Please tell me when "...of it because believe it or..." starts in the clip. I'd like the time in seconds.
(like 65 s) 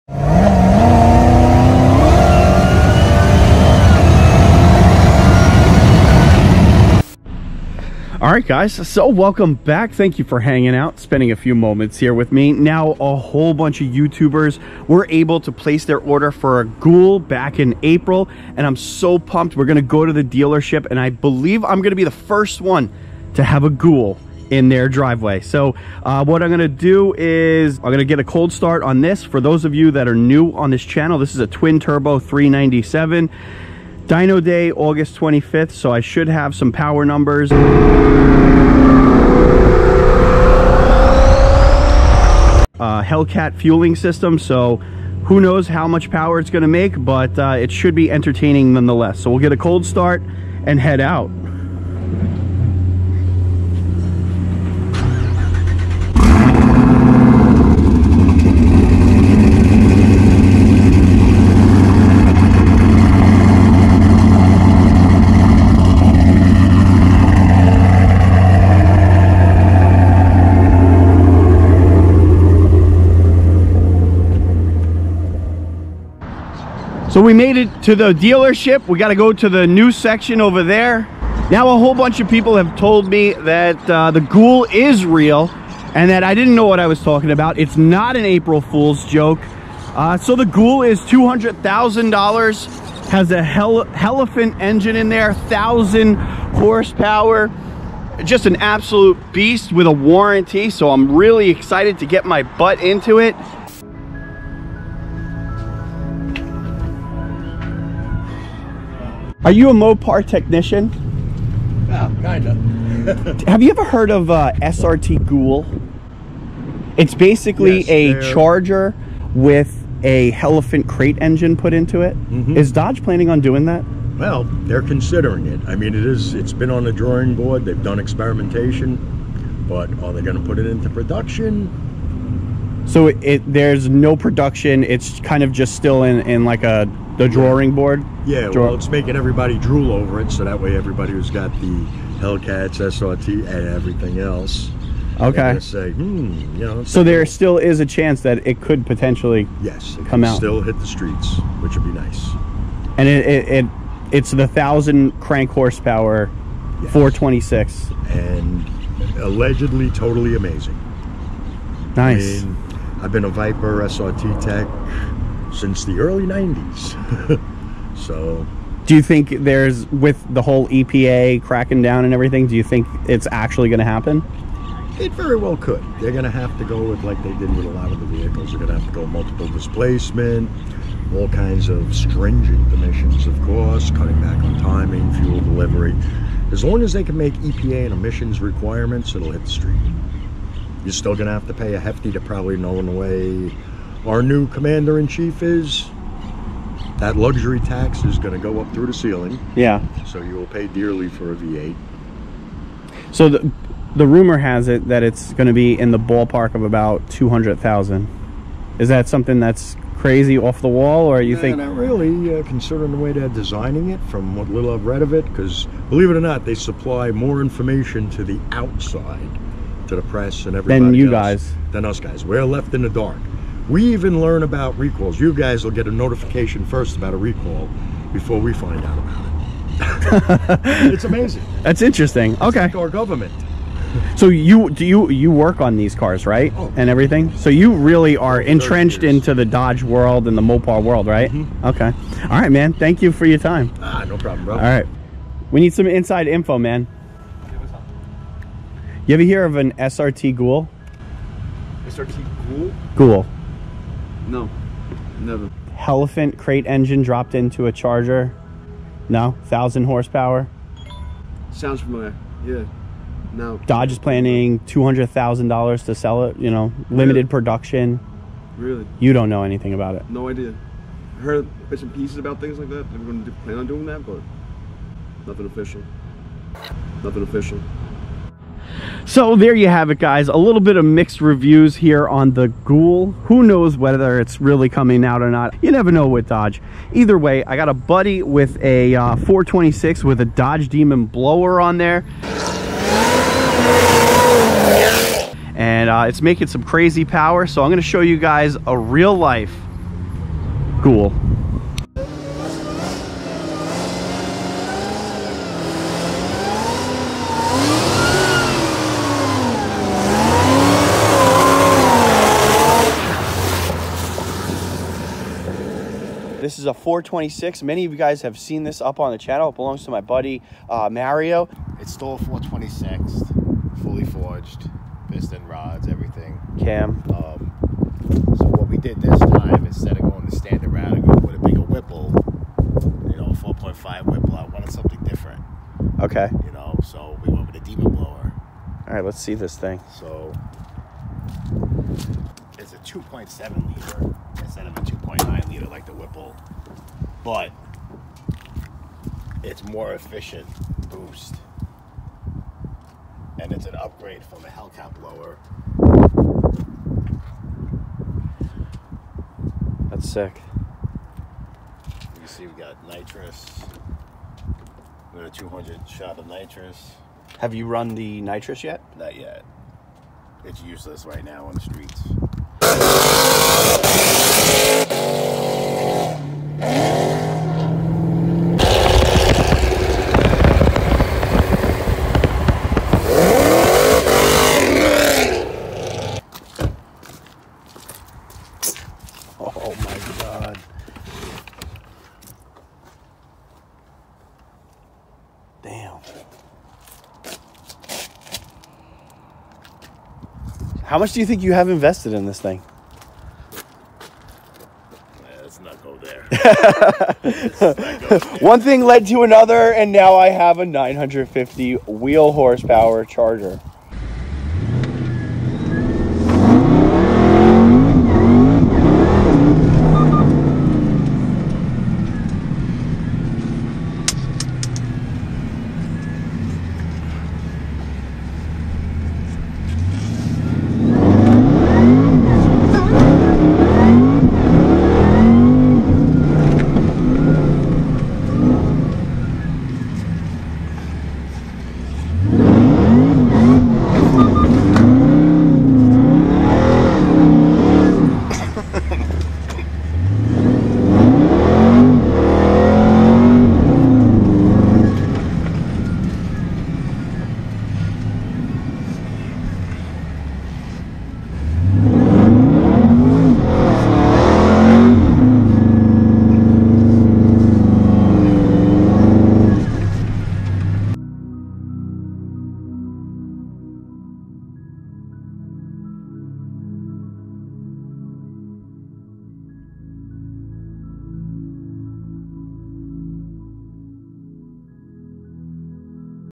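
215 s.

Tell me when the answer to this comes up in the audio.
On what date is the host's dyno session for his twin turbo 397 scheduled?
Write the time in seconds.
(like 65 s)
34 s.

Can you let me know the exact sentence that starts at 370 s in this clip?
It's useless right now on the streets.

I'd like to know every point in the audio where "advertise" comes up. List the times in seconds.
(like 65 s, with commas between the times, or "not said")
not said.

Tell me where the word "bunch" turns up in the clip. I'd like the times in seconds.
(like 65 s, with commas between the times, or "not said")
13 s, 81 s.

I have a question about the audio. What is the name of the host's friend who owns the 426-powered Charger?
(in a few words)
Mario.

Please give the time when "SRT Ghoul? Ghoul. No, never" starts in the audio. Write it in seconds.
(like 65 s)
251 s.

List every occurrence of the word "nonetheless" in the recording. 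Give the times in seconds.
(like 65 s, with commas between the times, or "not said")
48 s.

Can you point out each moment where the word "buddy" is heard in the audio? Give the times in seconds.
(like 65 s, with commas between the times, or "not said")
287 s, 320 s.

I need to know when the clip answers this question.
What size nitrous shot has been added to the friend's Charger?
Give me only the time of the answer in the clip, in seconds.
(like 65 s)
365 s.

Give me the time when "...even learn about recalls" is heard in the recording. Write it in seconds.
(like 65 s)
223 s.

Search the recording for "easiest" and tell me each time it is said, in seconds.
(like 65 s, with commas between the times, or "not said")
not said.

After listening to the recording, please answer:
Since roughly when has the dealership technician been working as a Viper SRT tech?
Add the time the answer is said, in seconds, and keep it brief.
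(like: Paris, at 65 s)
early 90s, at 165 s.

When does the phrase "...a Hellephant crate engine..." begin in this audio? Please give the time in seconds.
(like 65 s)
120 s.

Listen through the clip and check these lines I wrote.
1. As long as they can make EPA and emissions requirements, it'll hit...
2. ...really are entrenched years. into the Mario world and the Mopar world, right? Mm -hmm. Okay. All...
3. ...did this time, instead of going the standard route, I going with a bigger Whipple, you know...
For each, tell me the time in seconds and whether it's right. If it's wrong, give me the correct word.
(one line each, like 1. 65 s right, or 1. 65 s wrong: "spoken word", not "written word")
1. 186 s right
2. 237 s wrong: "Dodge", not "Mario"
3. 328 s right.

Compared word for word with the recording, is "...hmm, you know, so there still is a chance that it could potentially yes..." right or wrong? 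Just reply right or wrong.
right.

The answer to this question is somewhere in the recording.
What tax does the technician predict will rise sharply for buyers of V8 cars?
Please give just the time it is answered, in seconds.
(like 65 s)
197 s.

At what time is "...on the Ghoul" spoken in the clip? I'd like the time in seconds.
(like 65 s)
282 s.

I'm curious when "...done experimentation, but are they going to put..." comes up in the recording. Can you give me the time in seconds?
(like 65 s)
127 s.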